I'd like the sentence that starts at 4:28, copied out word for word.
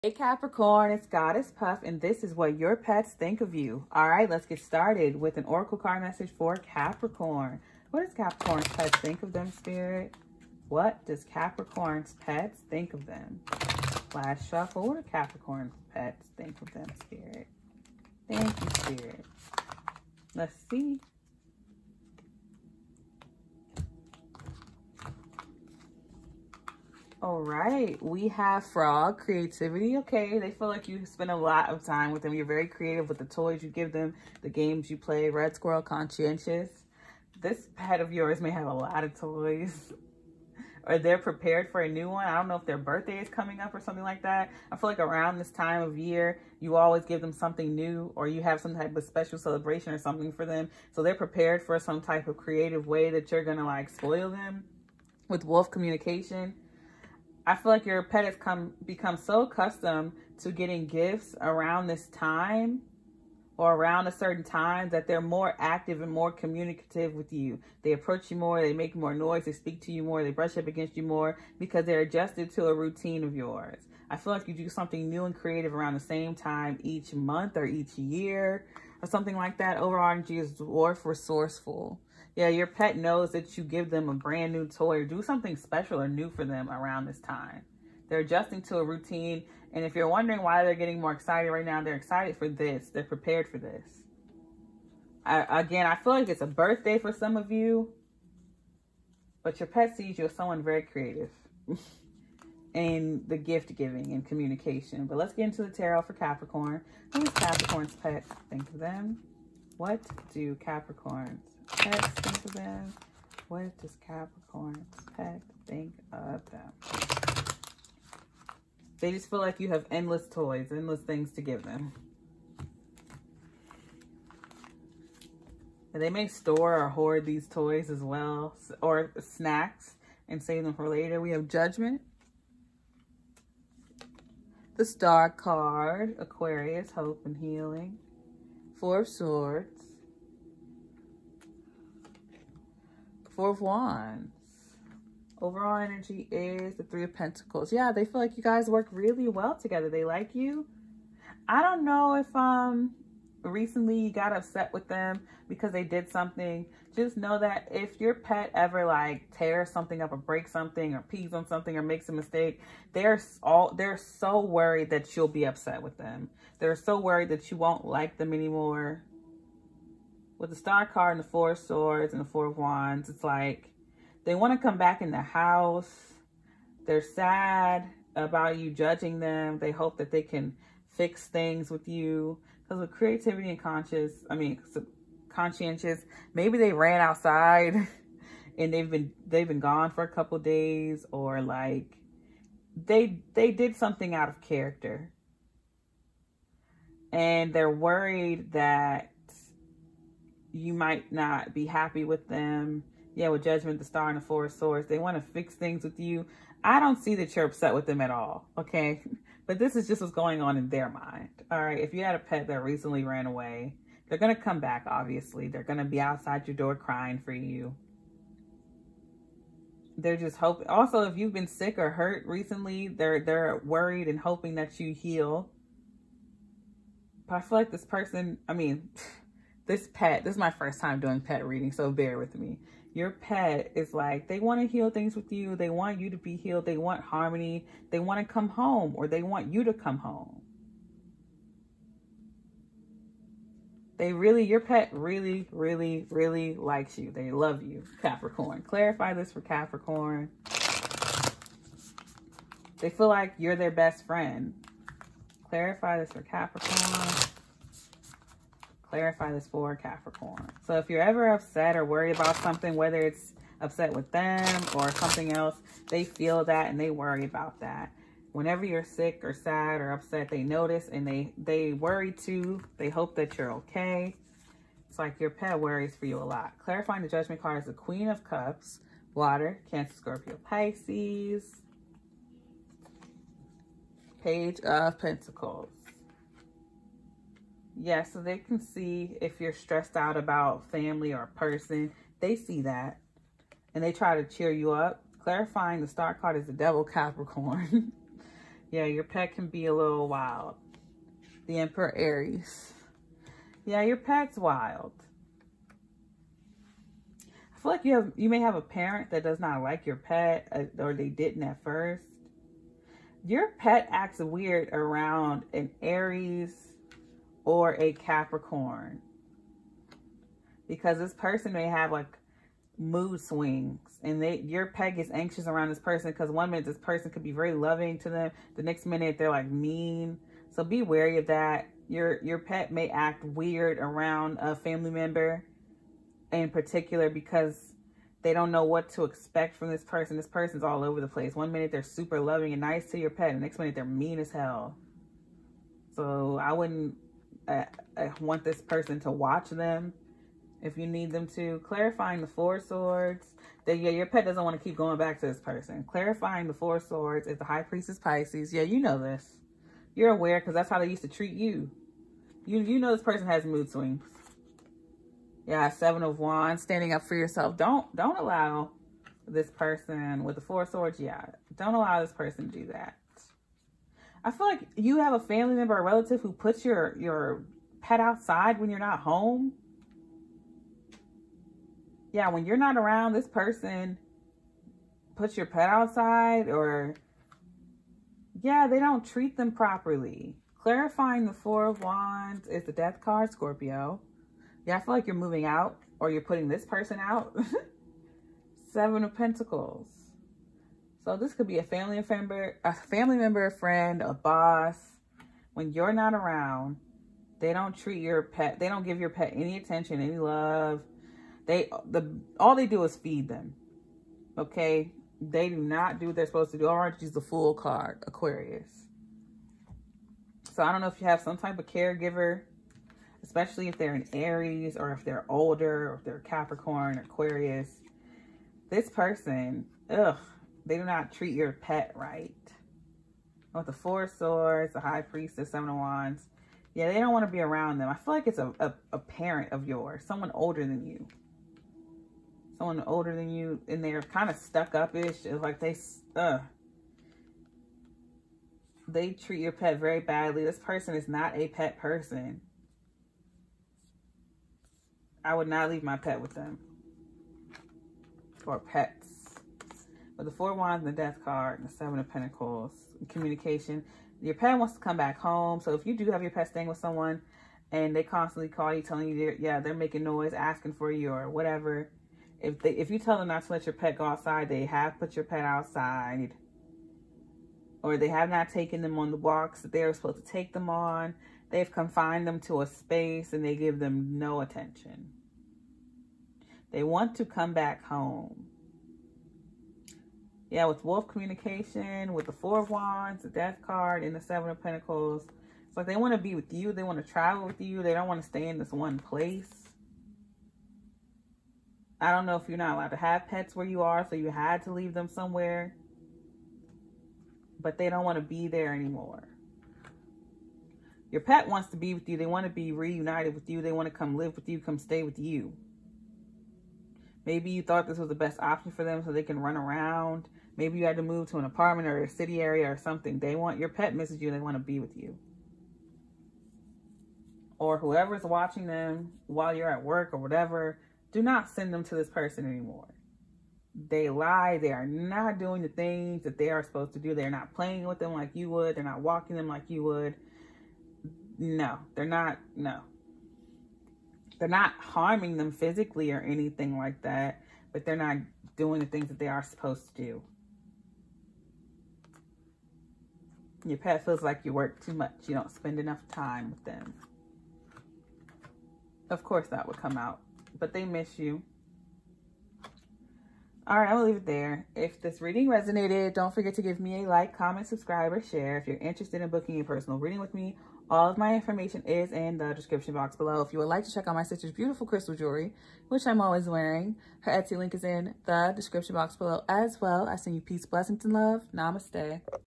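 Whenever you're sick or sad or upset, they notice and they, they worry too.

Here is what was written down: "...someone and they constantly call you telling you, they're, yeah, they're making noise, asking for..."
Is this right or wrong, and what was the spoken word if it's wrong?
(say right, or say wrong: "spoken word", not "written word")
right.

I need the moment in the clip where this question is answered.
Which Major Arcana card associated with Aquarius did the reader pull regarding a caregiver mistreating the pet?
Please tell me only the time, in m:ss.
6:57.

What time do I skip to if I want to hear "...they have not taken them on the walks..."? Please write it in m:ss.
7:57.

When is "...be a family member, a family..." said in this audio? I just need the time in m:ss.
6:41.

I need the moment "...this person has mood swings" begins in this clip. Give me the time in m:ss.
6:02.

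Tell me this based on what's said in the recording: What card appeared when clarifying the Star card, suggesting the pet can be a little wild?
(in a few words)
The Devil.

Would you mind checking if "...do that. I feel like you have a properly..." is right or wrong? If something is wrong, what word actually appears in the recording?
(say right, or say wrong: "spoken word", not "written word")
wrong: "family", not "properly".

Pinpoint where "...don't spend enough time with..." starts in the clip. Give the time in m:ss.
9:15.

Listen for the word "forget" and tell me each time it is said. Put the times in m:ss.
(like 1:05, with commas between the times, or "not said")
9:26.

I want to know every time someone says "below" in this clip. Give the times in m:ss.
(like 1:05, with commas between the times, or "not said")
9:33, 9:39.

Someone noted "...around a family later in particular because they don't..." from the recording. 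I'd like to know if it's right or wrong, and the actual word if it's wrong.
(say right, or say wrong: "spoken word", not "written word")
wrong: "member", not "later".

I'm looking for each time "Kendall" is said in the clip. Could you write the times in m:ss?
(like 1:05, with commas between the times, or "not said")
not said.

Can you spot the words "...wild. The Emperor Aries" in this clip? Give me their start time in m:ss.
5:00.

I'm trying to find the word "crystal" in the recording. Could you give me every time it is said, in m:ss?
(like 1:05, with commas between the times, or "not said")
9:34.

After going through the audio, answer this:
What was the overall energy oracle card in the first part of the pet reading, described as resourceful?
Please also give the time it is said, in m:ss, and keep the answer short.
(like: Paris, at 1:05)
Dwarf, at 1:20.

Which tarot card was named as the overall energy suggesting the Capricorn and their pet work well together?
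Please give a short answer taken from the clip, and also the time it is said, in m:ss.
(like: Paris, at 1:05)
Three of Pentacles, at 2:26.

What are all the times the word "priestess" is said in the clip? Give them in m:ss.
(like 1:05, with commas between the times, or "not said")
5:57, 7:15.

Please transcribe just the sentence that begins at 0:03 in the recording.
All right, let's get started with an oracle card message for Capricorn.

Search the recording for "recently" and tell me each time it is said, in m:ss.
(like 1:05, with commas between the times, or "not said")
2:33, 3:32, 3:42.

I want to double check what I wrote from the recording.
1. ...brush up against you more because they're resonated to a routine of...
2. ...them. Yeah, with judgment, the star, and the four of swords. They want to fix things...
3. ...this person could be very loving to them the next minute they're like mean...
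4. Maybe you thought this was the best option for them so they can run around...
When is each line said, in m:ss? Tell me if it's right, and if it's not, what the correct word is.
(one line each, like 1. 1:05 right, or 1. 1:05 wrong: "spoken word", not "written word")
1. 1:10 wrong: "adjusted", not "resonated"
2. 3:22 right
3. 5:26 right
4. 8:37 right.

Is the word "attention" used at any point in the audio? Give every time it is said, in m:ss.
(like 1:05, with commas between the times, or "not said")
6:49, 8:04.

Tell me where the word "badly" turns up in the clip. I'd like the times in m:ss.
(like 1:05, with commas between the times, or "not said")
7:29.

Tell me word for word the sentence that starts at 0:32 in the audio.
You're very creative with the toys you give them, the games you play.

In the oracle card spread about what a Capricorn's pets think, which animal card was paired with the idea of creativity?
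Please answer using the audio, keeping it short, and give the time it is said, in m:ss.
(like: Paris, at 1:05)
Frog, at 0:28.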